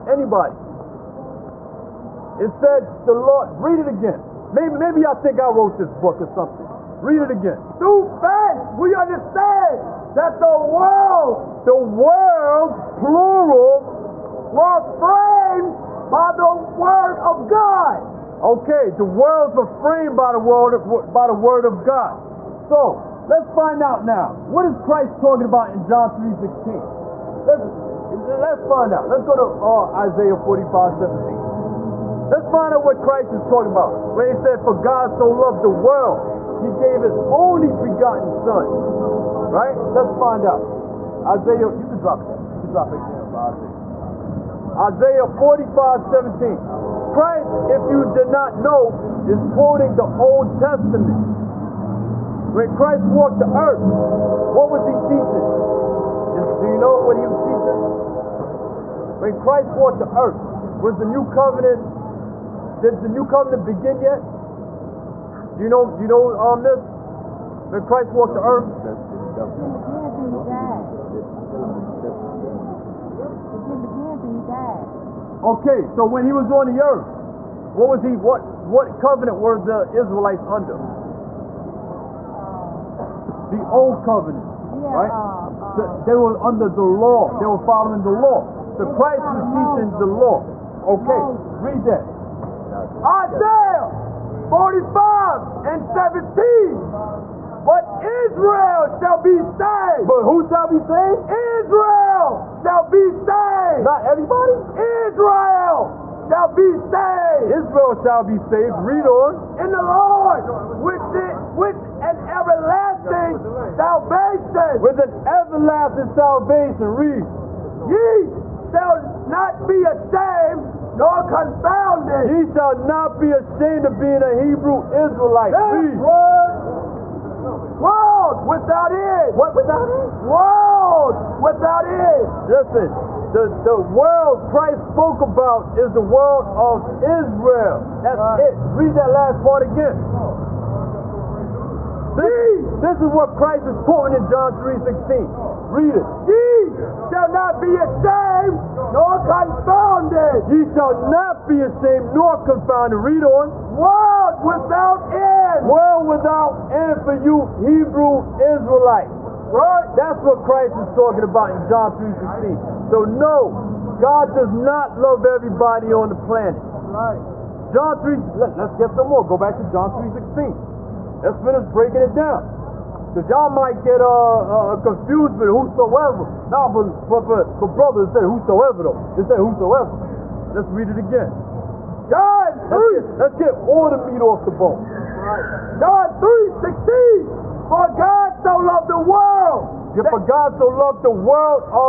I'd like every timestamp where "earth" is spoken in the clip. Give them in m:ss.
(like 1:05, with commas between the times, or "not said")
0:53, 1:00, 1:08, 1:16.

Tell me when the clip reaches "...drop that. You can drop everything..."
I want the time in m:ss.
0:41.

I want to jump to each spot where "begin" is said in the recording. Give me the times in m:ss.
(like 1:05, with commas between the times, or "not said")
1:03, 1:09, 1:13.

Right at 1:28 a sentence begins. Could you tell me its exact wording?
So Christ was teaching the law.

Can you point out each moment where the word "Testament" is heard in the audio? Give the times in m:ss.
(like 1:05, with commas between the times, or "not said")
0:50.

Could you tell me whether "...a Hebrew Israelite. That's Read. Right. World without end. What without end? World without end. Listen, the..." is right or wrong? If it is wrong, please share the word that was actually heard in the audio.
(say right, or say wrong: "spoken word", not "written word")
right.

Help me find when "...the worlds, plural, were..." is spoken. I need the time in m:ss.
0:11.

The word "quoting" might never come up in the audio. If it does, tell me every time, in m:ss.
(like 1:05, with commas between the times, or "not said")
0:49, 2:23.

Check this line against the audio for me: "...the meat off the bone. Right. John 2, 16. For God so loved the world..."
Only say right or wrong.
wrong.